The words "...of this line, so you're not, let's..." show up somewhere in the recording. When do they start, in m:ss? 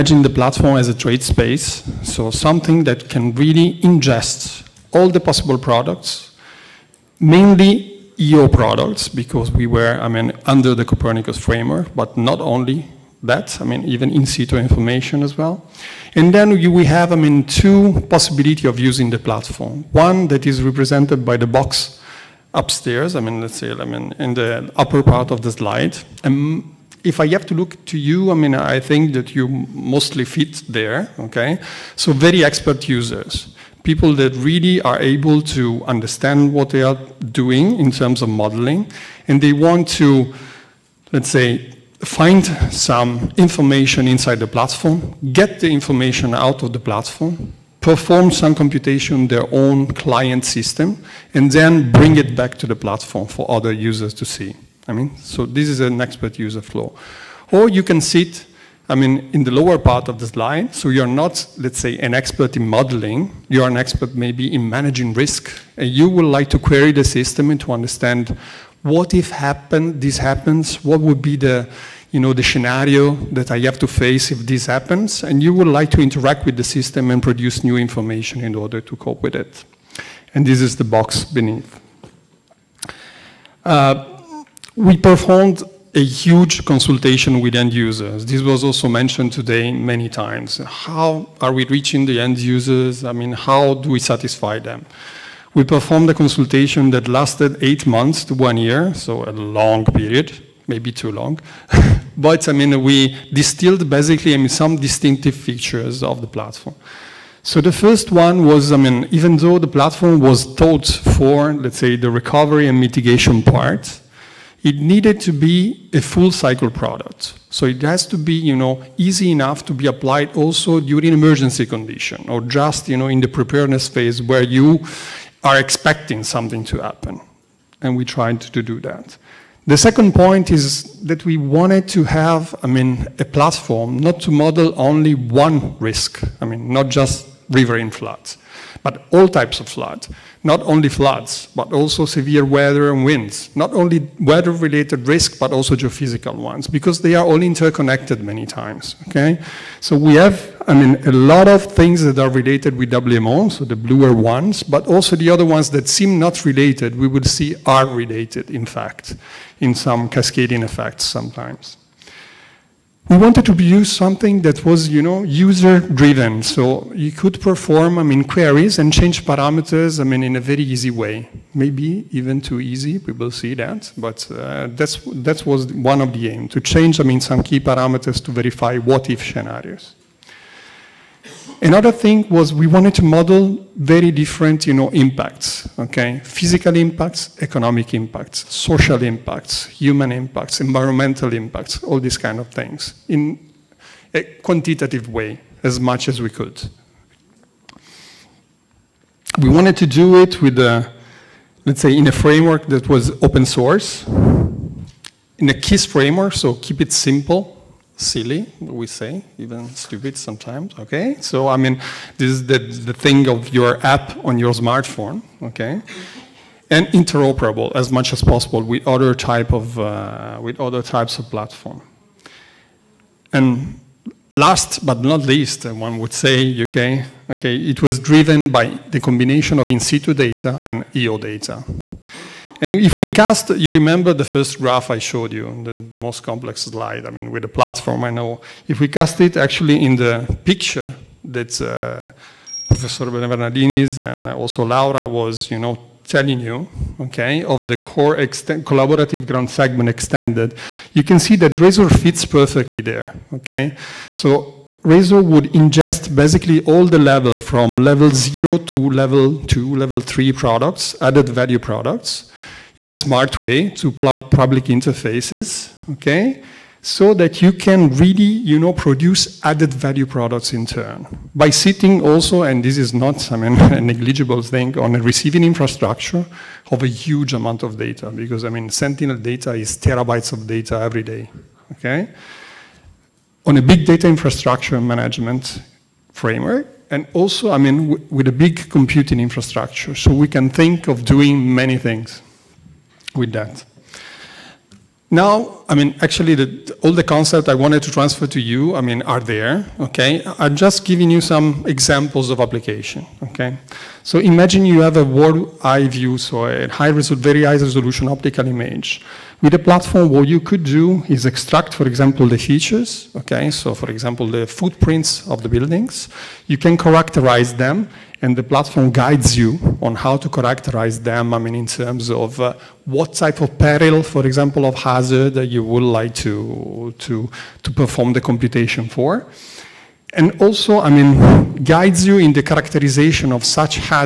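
1:00.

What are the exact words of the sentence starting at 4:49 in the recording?
So we can think of doing many things with that.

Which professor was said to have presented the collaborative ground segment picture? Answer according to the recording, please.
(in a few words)
Professor Bernardinis.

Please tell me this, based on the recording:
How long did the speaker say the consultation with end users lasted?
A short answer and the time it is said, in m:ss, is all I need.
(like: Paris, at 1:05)
eight months to one year, at 1:37.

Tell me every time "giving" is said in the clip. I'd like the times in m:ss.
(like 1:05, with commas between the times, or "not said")
5:00.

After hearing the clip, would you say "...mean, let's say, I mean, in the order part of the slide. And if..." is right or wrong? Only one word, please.
wrong.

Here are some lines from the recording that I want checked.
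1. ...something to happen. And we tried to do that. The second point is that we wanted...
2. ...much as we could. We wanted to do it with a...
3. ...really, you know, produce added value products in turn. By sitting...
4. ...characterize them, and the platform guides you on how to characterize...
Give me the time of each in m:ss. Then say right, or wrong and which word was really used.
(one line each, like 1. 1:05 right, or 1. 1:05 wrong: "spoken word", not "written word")
1. 2:06 right
2. 3:15 right
3. 4:27 right
4. 5:16 right.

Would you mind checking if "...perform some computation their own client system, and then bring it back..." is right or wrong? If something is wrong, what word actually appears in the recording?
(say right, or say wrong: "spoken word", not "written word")
right.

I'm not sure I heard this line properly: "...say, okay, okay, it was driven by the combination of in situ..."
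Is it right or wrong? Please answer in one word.
right.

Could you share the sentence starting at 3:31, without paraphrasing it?
So, I mean, this is the, the thing of your app on your smartphone, okay?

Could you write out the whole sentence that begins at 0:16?
And then we have, I mean, two possibility of using the platform.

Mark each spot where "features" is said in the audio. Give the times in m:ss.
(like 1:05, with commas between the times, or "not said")
1:45, 5:12.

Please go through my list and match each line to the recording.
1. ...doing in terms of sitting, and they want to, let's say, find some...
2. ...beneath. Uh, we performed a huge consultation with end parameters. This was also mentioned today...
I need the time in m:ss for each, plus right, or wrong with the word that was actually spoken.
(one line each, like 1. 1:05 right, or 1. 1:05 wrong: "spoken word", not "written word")
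1. 0:37 wrong: "modeling", not "sitting"
2. 1:21 wrong: "users", not "parameters".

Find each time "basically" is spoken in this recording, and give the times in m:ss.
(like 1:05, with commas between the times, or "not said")
1:43, 4:16.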